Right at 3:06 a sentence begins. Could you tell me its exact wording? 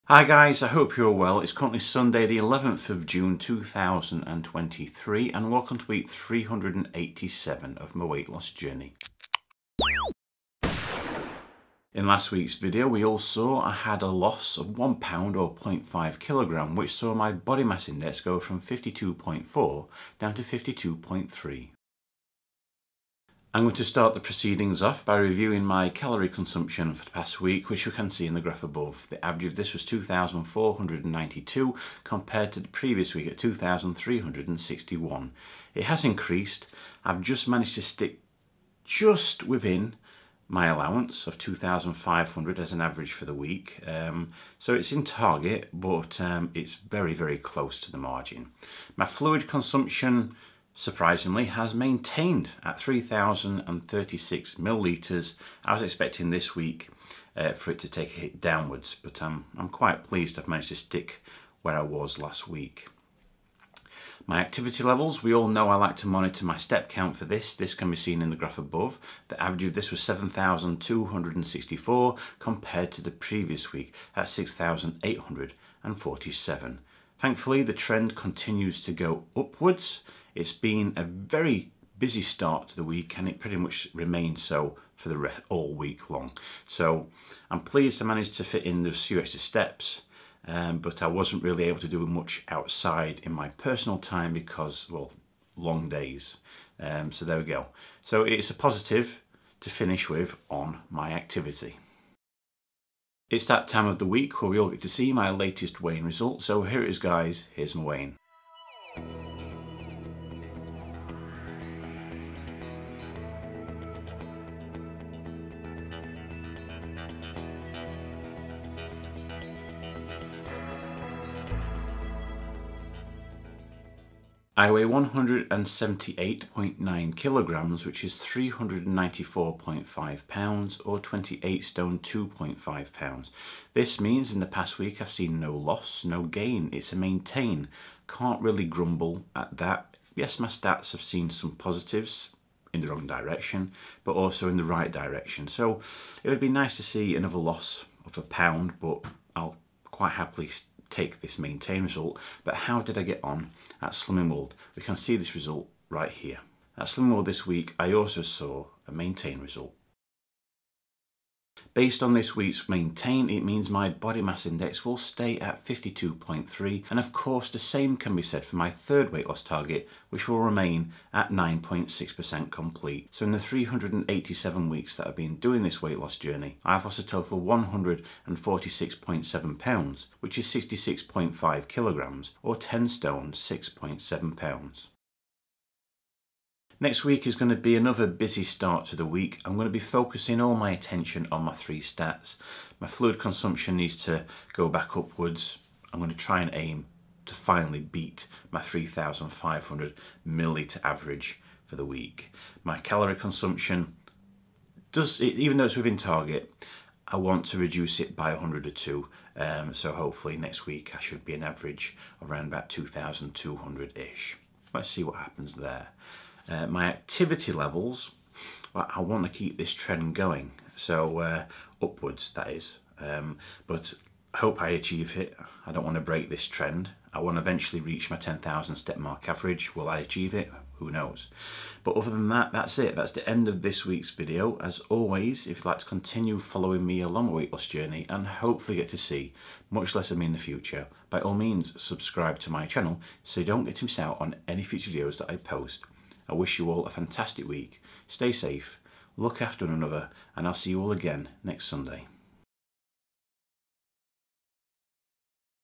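Next week is going to be another busy start to the week.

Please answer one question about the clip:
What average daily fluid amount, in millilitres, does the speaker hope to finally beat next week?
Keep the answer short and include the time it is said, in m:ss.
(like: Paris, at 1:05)
3,500 millilitres, at 3:18.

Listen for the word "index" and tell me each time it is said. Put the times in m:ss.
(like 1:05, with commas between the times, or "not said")
0:17, 2:44.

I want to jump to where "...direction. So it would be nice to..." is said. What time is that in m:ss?
2:24.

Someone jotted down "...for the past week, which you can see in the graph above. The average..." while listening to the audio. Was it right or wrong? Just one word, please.
right.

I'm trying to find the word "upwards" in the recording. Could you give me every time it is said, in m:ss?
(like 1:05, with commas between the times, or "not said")
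1:19, 3:14, 3:41.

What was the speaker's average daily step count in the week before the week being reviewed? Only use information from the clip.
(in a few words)
6,847.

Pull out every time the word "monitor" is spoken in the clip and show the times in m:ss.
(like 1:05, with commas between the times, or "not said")
1:06.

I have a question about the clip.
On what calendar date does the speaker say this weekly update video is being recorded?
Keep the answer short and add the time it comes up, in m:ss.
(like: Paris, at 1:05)
11th of June 2023, at 0:02.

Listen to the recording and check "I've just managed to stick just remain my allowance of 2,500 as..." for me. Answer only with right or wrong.
wrong.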